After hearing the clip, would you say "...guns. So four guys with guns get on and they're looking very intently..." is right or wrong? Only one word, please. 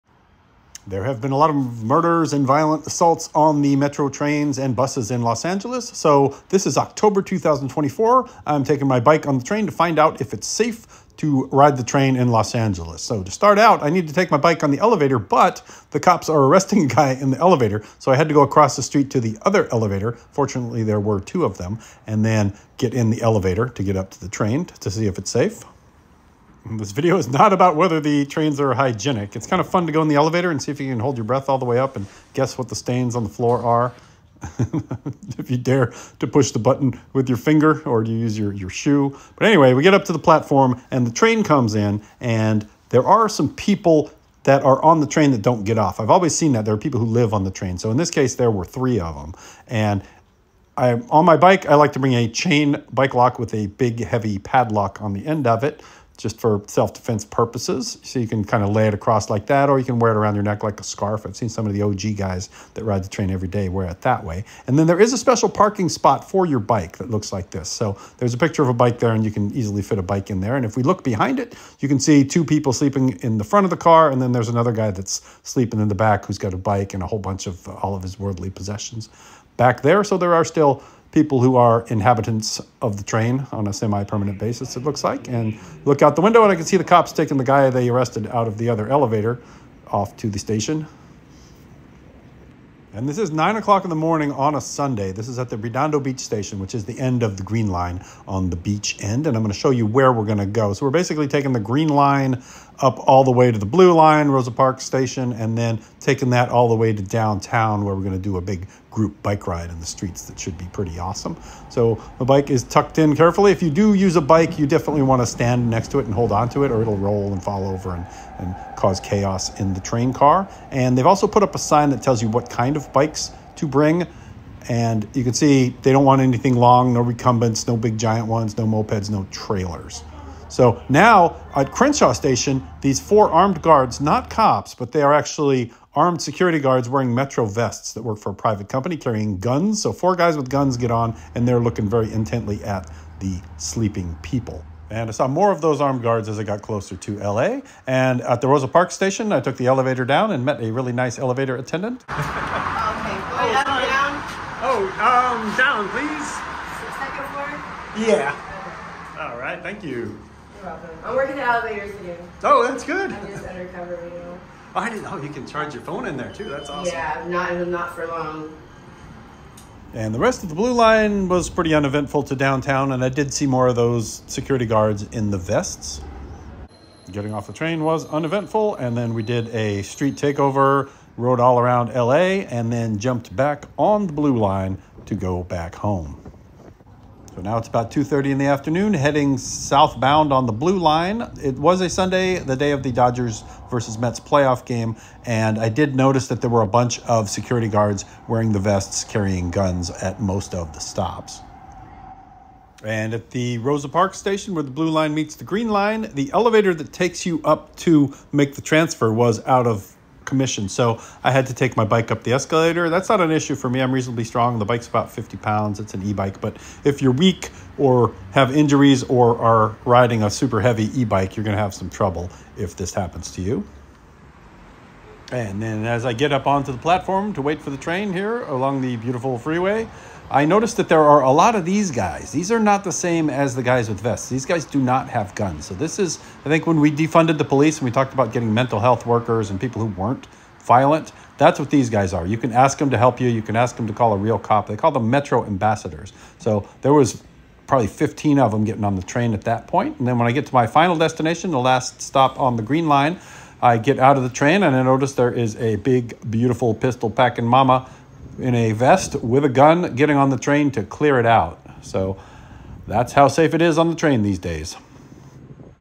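right.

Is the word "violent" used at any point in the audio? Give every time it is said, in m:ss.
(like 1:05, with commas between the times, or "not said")
0:02, 4:00.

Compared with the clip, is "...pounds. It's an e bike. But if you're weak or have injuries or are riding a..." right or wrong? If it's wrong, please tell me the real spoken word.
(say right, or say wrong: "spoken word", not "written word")
right.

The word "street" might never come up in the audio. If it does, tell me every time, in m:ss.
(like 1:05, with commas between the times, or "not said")
0:18, 1:49, 2:59.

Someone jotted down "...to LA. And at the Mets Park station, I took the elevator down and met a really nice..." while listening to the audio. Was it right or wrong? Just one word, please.
wrong.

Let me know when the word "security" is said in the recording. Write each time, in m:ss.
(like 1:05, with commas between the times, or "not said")
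2:16, 2:54, 3:17.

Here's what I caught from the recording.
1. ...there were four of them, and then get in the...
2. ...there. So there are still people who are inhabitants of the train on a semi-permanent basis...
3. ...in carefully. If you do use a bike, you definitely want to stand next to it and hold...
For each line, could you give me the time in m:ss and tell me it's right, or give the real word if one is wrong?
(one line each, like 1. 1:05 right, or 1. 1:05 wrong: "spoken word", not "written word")
1. 0:20 wrong: "two", not "four"
2. 1:19 right
3. 1:52 right.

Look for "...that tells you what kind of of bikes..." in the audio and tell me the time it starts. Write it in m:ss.
2:01.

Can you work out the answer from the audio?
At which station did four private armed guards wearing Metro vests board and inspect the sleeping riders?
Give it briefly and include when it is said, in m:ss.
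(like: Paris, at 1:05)
Crenshaw Station, at 2:11.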